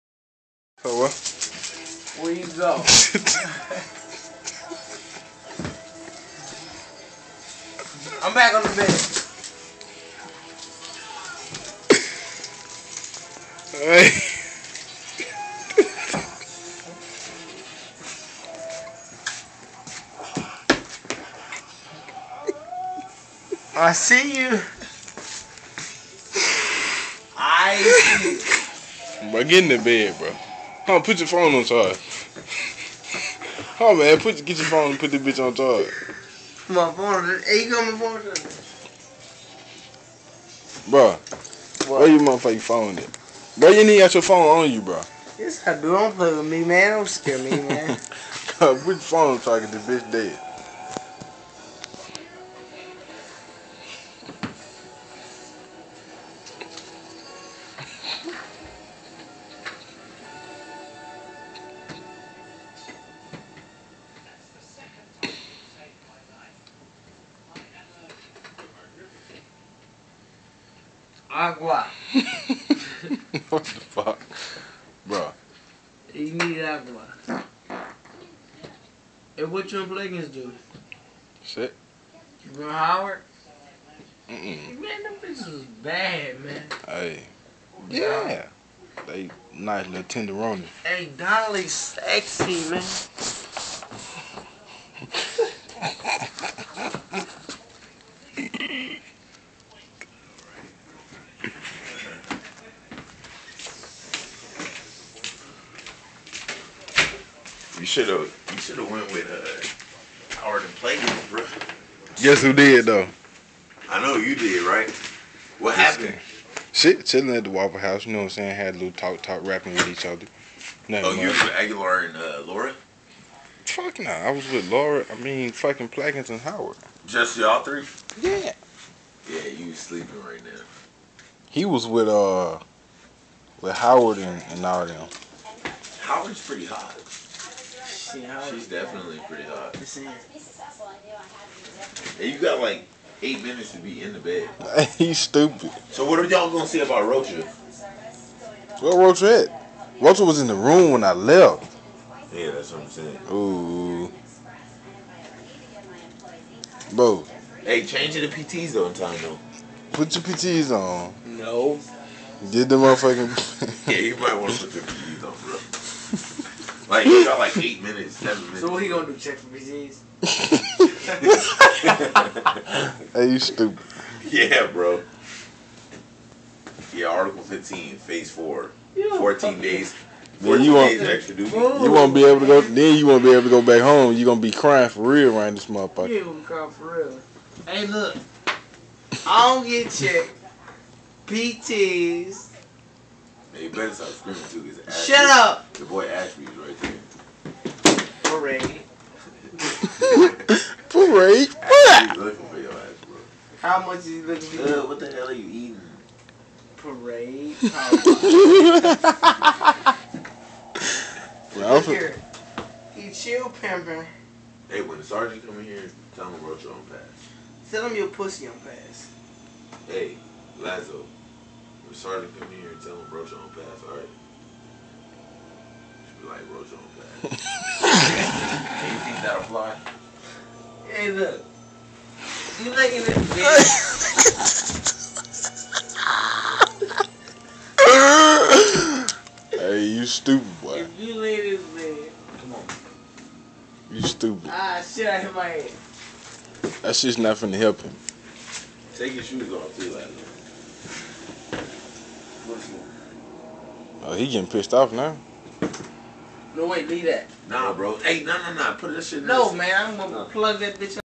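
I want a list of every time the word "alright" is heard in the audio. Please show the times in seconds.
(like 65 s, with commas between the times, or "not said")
13 s, 223 s.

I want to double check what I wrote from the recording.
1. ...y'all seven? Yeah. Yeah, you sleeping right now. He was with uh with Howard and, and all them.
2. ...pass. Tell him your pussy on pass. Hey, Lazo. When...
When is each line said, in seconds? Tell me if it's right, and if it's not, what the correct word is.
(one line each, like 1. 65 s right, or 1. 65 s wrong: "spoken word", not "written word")
1. 127 s wrong: "three", not "seven"
2. 216 s right.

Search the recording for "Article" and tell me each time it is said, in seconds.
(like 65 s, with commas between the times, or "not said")
177 s.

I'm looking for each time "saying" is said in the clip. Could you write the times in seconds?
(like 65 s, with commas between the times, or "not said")
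118 s, 152 s.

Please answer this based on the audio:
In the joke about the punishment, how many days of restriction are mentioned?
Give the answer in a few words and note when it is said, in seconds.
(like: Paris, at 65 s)
14, at 179 s.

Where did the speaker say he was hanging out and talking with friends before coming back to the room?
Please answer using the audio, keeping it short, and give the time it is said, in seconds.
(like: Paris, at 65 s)
Waffle House, at 117 s.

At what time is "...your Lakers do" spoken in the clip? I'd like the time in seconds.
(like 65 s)
79 s.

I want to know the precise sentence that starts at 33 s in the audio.
Oh man, put get your phone and put the bitch on charge.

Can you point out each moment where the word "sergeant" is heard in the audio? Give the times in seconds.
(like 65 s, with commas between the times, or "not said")
215 s, 221 s.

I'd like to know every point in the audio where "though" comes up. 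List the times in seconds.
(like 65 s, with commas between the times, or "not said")
112 s, 159 s.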